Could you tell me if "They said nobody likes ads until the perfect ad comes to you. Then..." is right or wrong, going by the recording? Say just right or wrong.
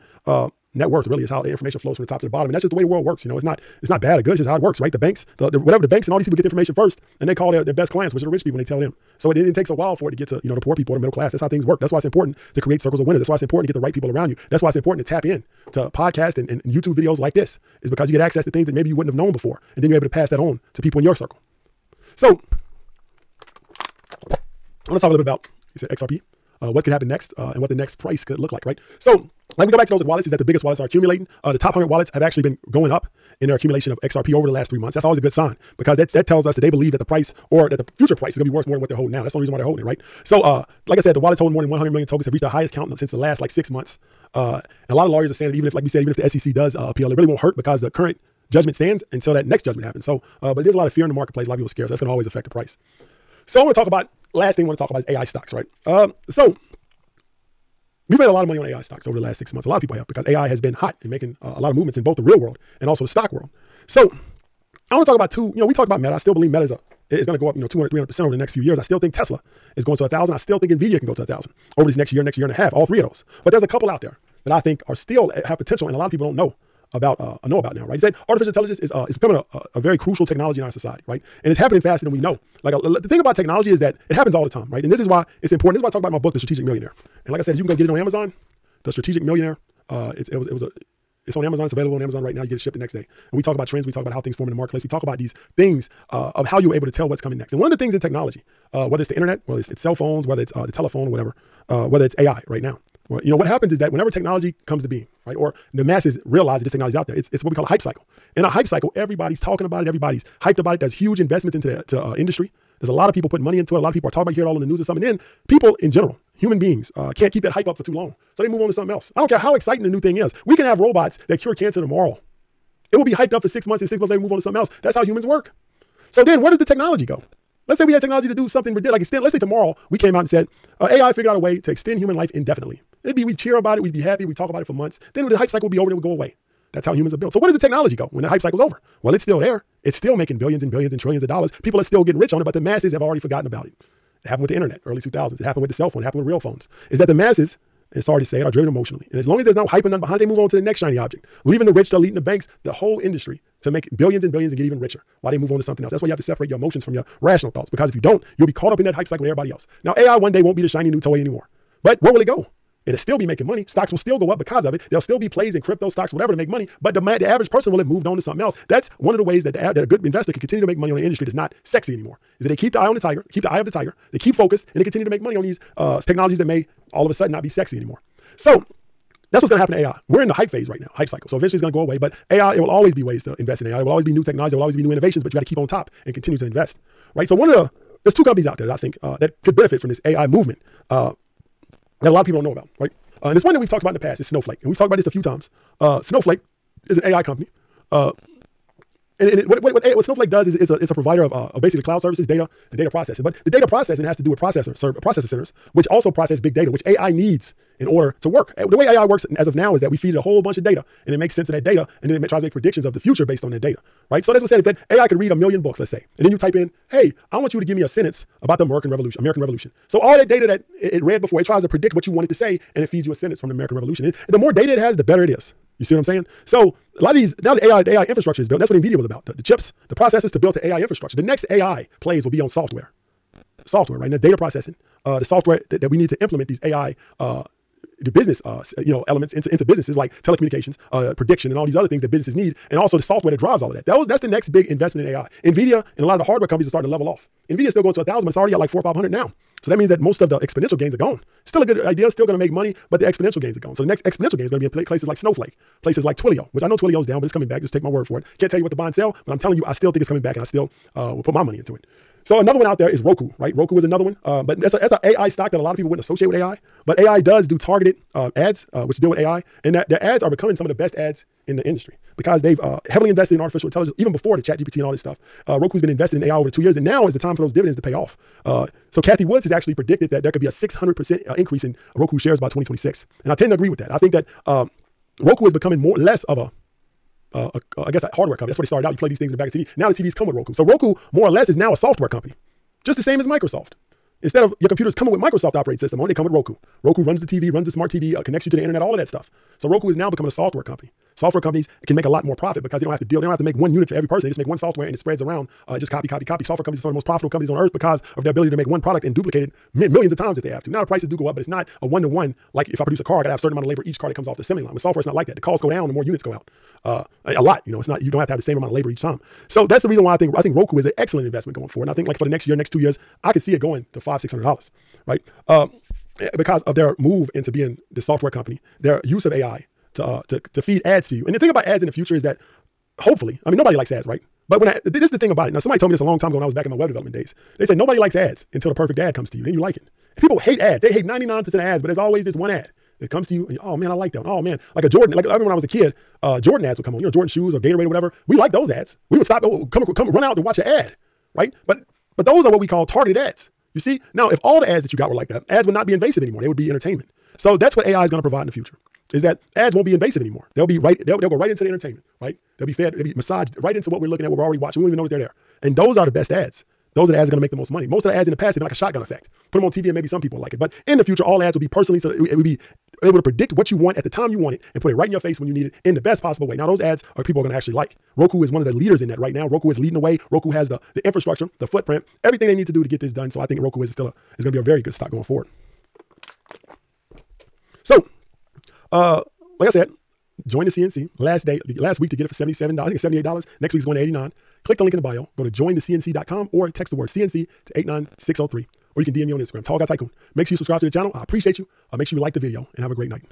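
right.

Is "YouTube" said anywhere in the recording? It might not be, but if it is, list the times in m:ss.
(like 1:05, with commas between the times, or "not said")
0:16.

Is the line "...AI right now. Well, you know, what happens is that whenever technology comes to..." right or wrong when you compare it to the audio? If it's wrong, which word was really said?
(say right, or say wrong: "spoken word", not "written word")
right.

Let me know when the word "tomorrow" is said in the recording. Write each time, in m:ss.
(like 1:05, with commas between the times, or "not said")
2:01, 2:09.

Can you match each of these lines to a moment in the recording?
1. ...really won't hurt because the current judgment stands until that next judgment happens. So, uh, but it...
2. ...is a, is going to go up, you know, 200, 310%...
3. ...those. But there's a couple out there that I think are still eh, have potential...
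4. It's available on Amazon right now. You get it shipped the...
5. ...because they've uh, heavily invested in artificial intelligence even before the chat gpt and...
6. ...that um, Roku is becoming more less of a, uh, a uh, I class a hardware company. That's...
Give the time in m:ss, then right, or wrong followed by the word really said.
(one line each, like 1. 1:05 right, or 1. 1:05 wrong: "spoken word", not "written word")
1. 0:47 right
2. 1:06 wrong: "300", not "310"
3. 1:13 right
4. 1:31 right
5. 4:32 right
6. 4:44 wrong: "guess", not "class".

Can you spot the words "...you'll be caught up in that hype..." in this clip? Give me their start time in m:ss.
2:38.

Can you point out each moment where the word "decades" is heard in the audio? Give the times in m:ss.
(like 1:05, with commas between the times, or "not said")
not said.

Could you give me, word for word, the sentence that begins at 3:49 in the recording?
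The, the chips, the processes to build the AI infrastructure.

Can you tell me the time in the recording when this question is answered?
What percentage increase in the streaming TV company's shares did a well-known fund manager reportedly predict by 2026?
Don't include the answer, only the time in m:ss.
4:40.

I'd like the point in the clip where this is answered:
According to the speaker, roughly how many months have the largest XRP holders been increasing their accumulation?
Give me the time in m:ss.
0:34.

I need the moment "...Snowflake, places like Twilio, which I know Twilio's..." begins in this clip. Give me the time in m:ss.
4:15.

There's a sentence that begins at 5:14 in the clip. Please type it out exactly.
With software, it's not like that.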